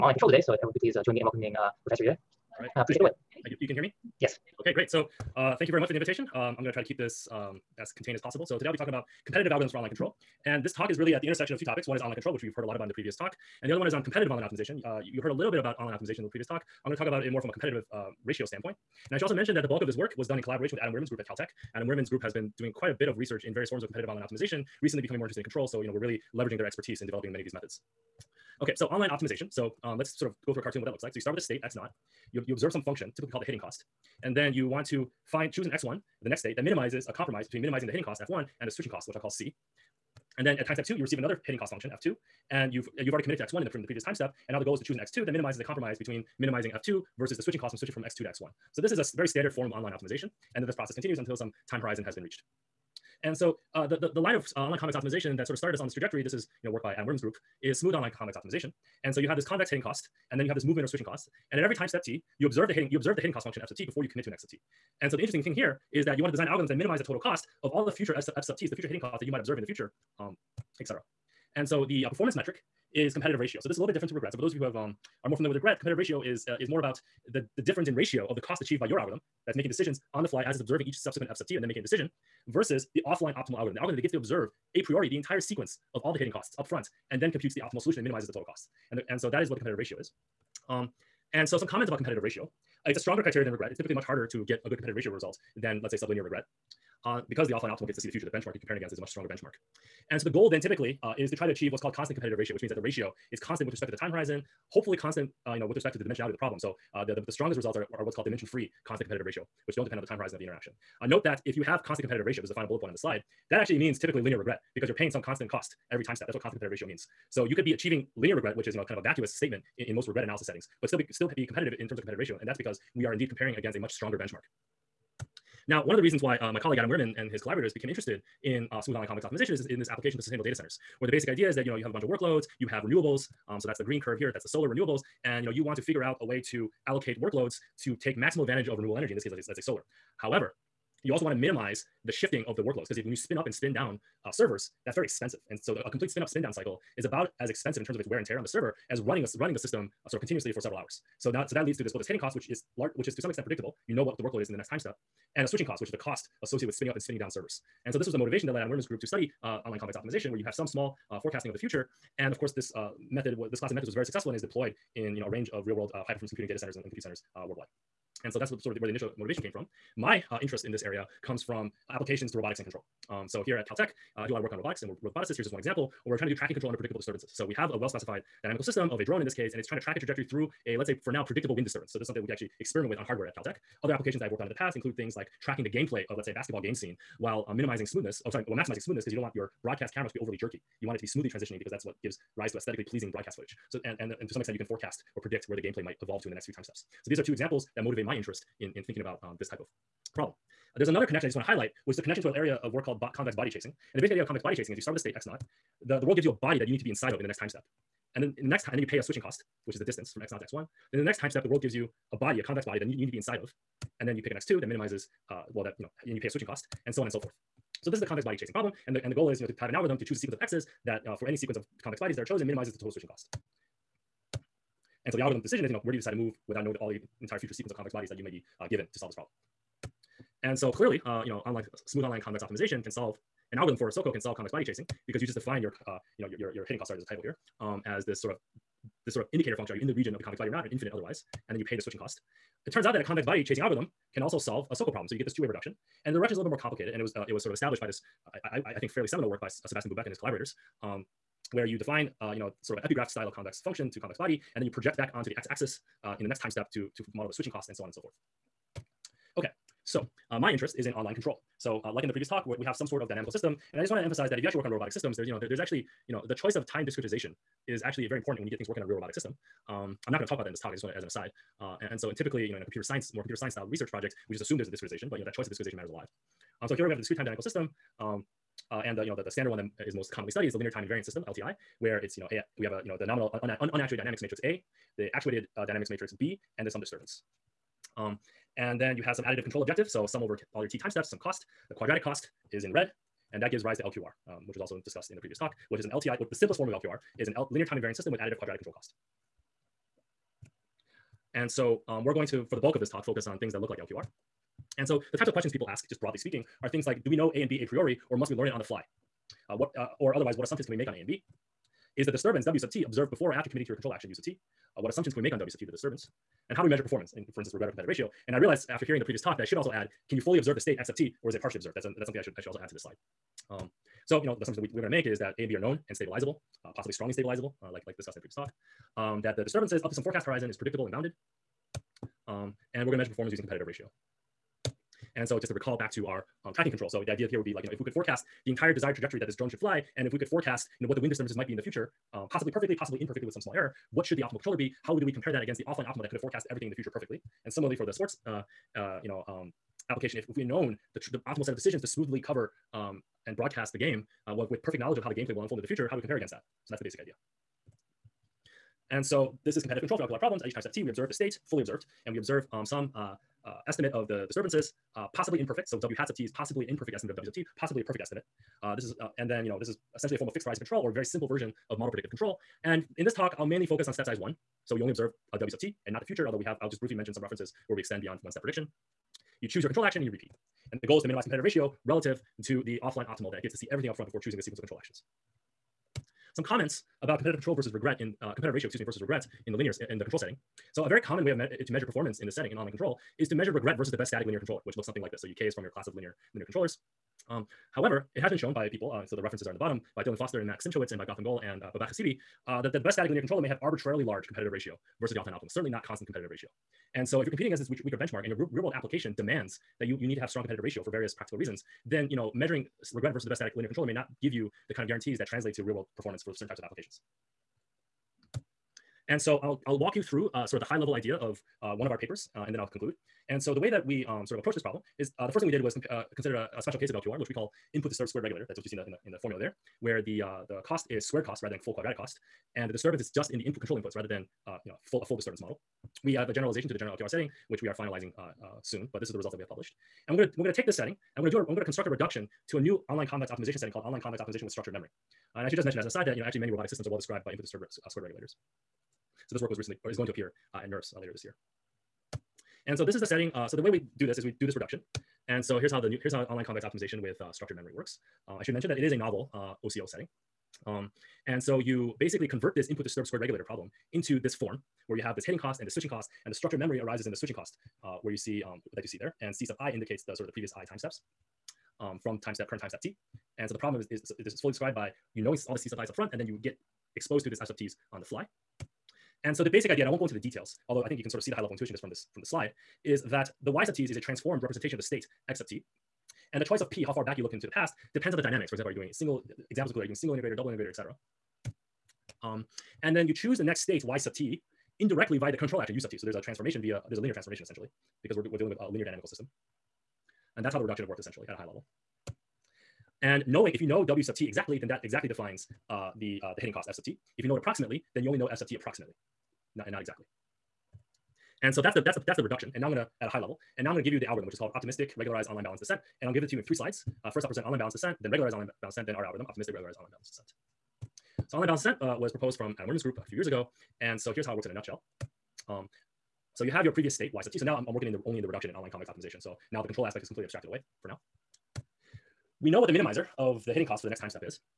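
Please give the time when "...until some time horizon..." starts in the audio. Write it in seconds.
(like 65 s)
51 s.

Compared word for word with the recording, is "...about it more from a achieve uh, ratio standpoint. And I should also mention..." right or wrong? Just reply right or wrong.
wrong.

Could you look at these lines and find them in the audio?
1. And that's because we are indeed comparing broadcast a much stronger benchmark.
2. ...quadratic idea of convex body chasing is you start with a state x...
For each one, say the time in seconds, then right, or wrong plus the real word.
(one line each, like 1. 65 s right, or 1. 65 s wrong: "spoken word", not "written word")
1. 122 s wrong: "against", not "broadcast"
2. 204 s wrong: "basic", not "quadratic".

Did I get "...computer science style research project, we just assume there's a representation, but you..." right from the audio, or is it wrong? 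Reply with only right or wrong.
wrong.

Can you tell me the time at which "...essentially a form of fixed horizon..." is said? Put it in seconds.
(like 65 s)
369 s.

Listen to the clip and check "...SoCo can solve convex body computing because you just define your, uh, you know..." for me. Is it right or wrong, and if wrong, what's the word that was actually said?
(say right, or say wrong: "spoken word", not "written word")
wrong: "chasing", not "computing".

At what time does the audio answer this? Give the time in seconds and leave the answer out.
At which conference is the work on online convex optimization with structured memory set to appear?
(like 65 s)
450 s.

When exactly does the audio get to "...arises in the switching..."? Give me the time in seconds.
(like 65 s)
466 s.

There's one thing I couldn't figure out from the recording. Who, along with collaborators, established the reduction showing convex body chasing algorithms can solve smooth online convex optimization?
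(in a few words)
Sebastian Bubeck.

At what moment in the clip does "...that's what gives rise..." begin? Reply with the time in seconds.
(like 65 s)
191 s.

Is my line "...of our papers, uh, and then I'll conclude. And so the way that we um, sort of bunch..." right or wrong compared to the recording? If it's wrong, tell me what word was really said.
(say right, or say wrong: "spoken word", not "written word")
wrong: "approach", not "bunch".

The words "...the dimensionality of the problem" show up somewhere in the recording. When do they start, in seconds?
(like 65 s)
105 s.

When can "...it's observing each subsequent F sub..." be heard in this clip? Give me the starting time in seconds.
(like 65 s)
80 s.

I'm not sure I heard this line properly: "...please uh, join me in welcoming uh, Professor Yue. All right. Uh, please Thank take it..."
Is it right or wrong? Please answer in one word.
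right.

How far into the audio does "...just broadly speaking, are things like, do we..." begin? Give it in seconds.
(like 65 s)
305 s.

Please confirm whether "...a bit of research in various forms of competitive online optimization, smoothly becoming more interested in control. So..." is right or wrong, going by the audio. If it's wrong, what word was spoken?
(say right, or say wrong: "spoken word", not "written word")
wrong: "recently", not "smoothly".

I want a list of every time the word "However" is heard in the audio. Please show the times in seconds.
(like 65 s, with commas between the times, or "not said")
140 s, 397 s.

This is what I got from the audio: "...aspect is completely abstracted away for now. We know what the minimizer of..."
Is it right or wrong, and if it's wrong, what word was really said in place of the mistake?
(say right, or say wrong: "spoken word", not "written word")
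right.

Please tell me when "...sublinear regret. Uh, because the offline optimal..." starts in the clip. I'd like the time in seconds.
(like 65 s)
95 s.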